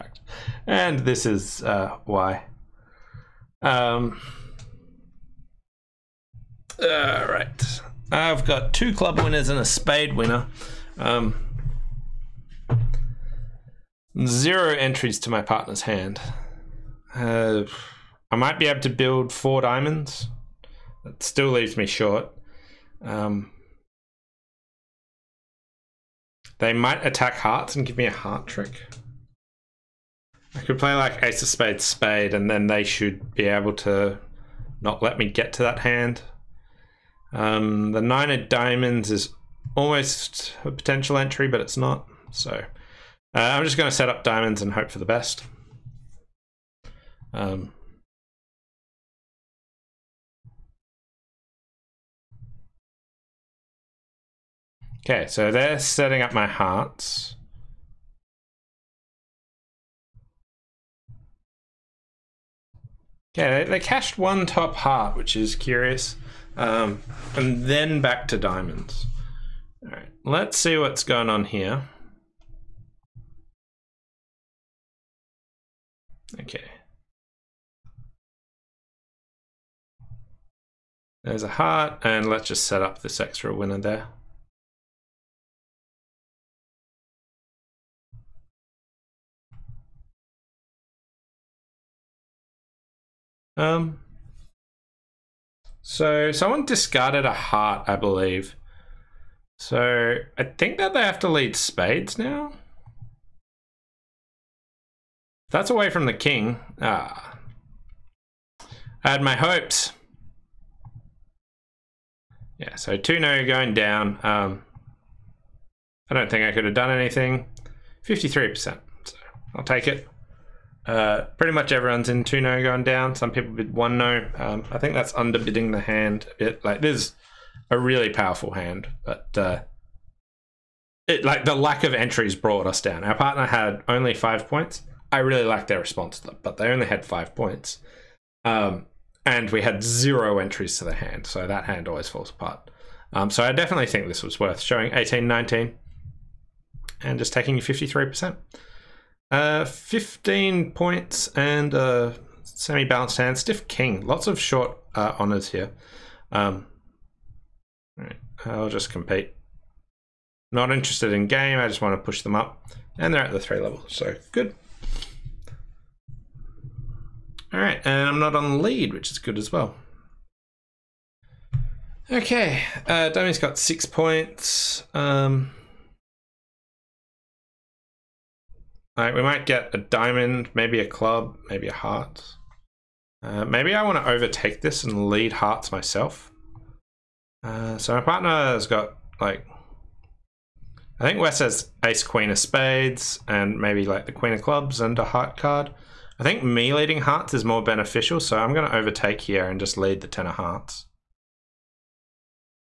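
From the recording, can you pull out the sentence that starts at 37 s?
Um, the nine of diamonds is almost a potential entry, but it's not.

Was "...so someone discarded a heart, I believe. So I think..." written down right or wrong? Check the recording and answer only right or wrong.
right.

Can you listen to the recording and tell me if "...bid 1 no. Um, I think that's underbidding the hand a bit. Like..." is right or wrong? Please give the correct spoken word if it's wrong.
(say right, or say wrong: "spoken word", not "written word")
right.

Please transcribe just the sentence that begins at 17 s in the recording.
Uh, I might be able to build four diamonds.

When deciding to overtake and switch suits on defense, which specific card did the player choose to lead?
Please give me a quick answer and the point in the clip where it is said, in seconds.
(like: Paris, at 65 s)
Ten of hearts, at 200 s.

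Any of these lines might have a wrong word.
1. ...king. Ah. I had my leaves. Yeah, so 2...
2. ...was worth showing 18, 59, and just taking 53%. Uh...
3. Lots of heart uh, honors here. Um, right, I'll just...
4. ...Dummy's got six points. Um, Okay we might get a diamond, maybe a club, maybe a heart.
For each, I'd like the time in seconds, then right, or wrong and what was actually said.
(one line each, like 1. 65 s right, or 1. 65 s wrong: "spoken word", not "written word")
1. 106 s wrong: "hopes", not "leaves"
2. 144 s wrong: "19", not "59"
3. 154 s wrong: "short", not "heart"
4. 173 s wrong: "Like", not "Okay".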